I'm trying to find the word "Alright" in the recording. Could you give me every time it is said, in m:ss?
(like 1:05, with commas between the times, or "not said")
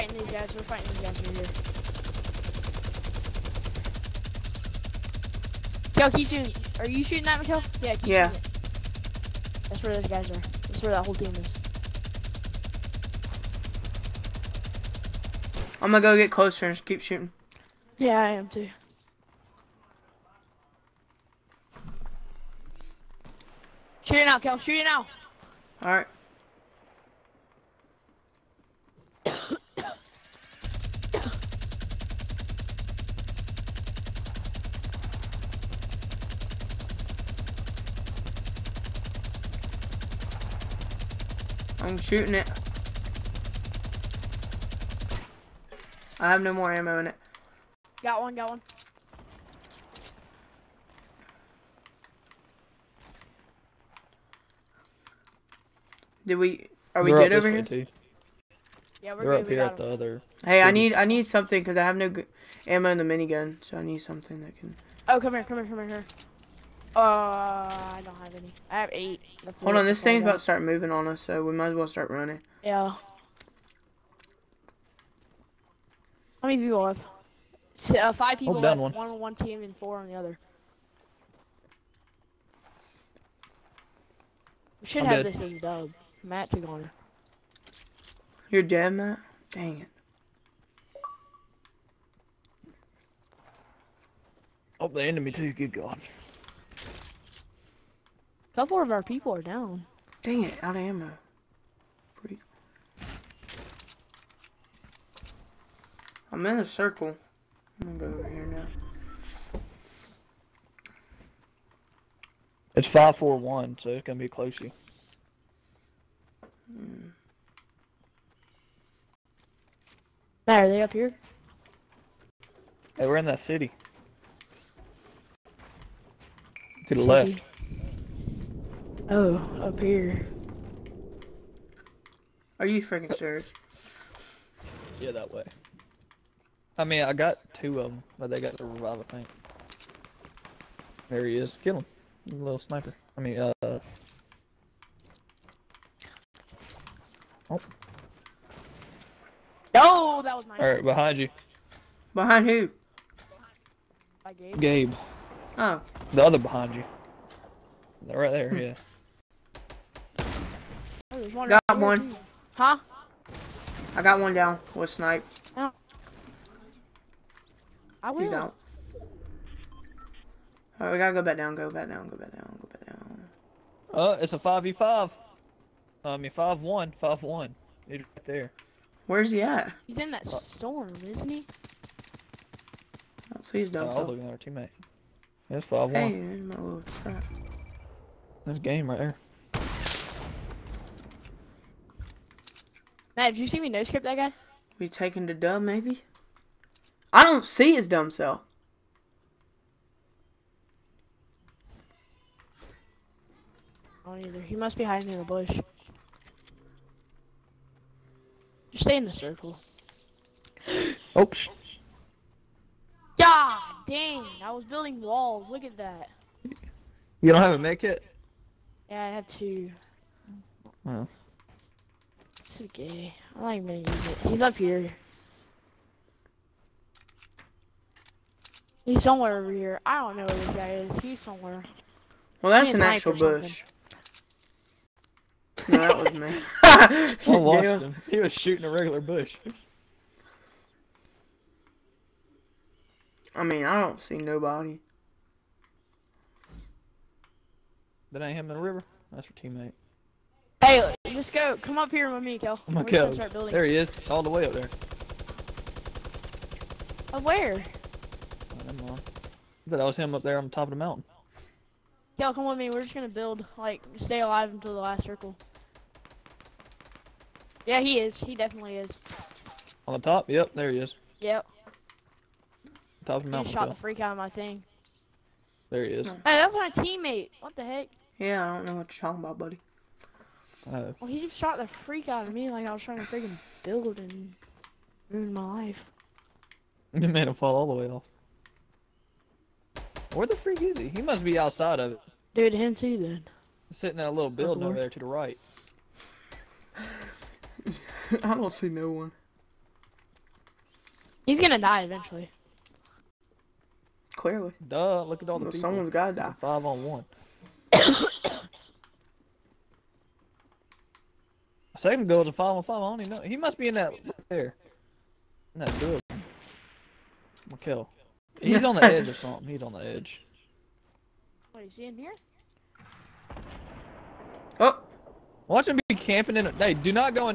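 2:30, 2:50.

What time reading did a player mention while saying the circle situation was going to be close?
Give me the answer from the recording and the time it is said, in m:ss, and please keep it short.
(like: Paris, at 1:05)
541, at 1:52.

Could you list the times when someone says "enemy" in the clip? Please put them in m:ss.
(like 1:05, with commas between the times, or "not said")
1:35.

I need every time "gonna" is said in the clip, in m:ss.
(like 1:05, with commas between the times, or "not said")
0:15, 1:47, 1:54, 3:43, 4:22, 5:01, 5:17.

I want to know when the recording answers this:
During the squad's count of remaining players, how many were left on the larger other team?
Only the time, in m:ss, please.
1:19.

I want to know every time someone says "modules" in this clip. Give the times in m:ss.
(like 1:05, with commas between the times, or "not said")
not said.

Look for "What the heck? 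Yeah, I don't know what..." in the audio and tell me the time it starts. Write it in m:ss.
4:37.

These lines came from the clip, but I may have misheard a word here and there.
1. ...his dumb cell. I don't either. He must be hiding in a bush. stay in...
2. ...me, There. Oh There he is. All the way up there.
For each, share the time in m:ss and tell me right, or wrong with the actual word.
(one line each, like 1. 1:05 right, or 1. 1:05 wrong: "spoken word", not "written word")
1. 3:17 right
2. 4:12 wrong: "Kel", not "There".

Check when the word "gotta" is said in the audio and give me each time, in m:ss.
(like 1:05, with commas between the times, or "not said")
2:50, 5:05.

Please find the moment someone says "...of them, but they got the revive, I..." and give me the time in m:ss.
2:17.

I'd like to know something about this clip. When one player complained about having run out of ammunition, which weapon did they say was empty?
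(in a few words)
minigun.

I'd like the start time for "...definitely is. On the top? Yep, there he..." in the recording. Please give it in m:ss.
4:28.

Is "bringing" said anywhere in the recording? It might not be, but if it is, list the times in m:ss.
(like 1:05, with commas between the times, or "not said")
not said.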